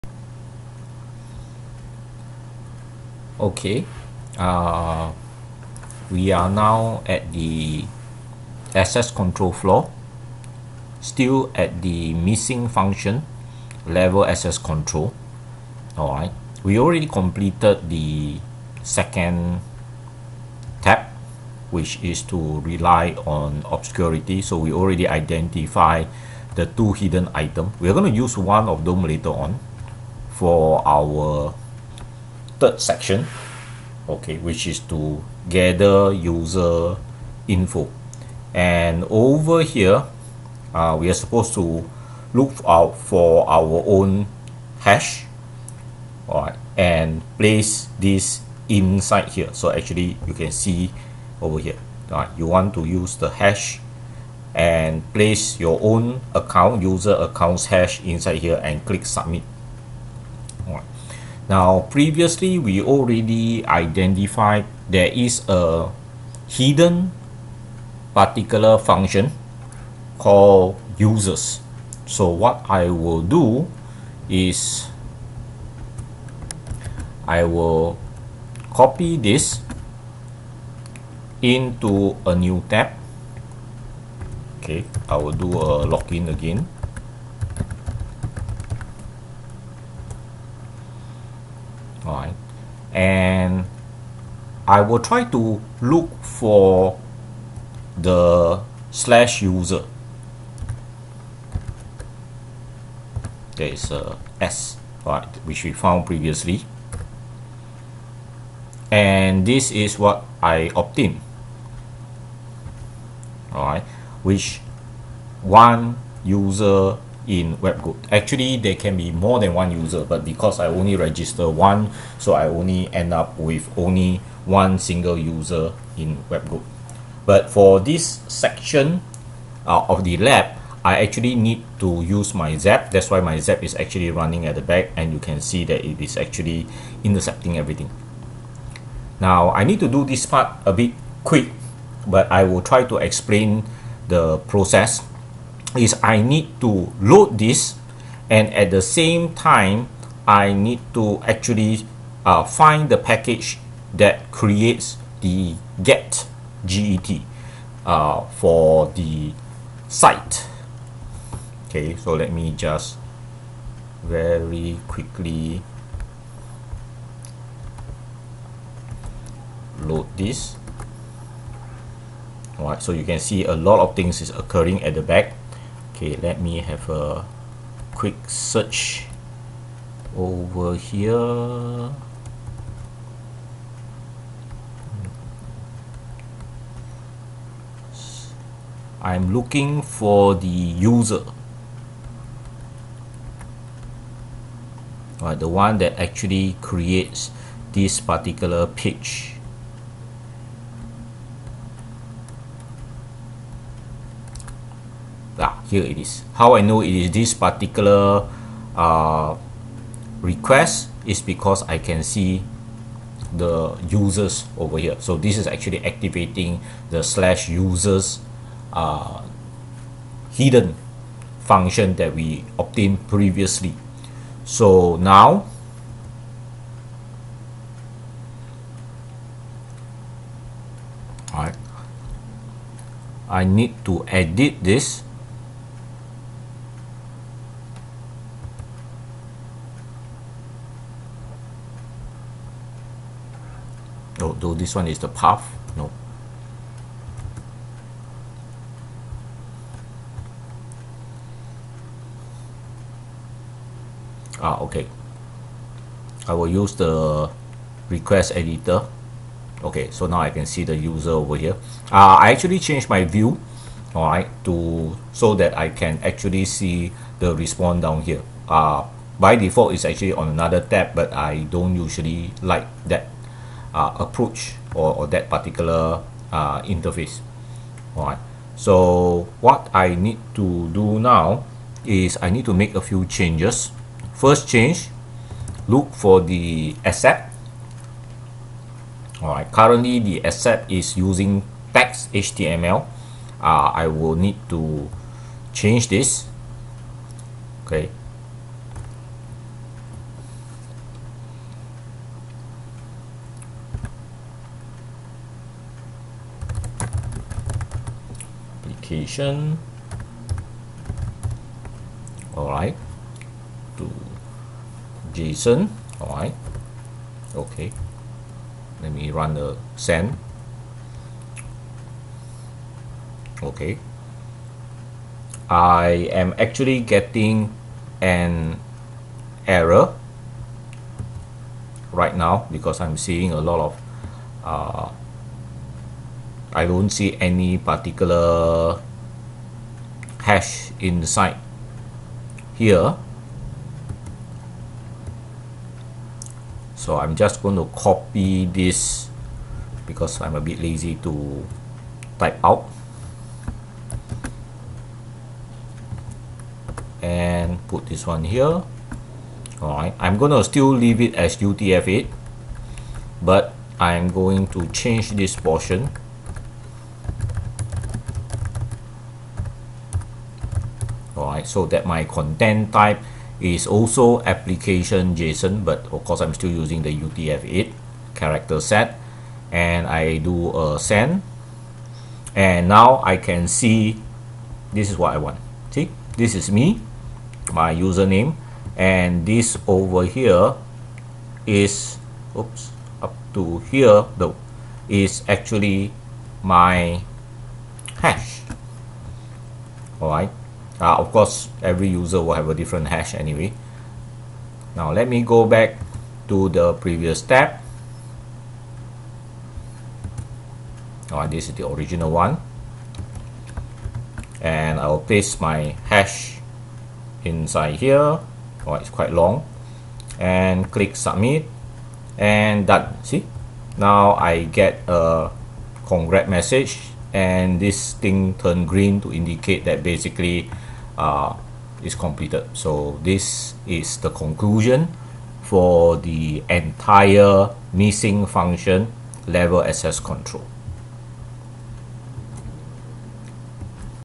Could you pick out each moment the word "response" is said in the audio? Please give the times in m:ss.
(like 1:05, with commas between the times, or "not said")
4:27.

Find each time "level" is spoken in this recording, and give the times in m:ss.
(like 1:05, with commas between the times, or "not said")
0:13, 7:19.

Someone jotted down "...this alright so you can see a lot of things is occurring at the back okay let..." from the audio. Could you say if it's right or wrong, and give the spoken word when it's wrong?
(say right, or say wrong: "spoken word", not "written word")
right.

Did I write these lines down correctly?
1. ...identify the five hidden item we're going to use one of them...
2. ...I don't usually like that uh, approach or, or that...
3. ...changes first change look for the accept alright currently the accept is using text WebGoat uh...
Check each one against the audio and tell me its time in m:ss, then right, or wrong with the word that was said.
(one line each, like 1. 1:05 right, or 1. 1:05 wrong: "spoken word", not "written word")
1. 0:25 wrong: "two", not "five"
2. 4:31 right
3. 4:43 wrong: "HTML", not "WebGoat".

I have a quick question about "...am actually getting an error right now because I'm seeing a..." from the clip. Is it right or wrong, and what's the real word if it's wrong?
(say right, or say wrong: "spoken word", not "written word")
right.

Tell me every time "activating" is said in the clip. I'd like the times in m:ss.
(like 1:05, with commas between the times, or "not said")
3:35.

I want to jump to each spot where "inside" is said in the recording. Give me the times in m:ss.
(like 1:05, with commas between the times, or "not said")
0:48, 0:58, 5:40, 6:57.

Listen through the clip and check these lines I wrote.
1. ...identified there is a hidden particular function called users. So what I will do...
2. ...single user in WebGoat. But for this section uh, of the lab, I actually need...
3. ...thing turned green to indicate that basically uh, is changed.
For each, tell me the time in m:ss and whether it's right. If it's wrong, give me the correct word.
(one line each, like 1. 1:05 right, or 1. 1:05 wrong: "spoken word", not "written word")
1. 1:03 right
2. 2:04 right
3. 7:07 wrong: "completed", not "changed".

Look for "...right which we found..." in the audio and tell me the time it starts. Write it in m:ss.
1:45.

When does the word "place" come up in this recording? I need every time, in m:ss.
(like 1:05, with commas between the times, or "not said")
0:47, 0:55.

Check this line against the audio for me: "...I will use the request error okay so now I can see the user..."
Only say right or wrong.
wrong.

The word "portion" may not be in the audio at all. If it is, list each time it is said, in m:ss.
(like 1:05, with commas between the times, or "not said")
6:05.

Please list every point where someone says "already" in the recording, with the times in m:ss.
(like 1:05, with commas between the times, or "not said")
0:16, 0:24, 1:02.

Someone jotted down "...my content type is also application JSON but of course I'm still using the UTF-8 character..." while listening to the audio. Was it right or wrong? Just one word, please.
right.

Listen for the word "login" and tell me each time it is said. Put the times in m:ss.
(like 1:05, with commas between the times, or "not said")
1:25.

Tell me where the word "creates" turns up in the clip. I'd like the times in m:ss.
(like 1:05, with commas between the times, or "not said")
2:34, 3:16.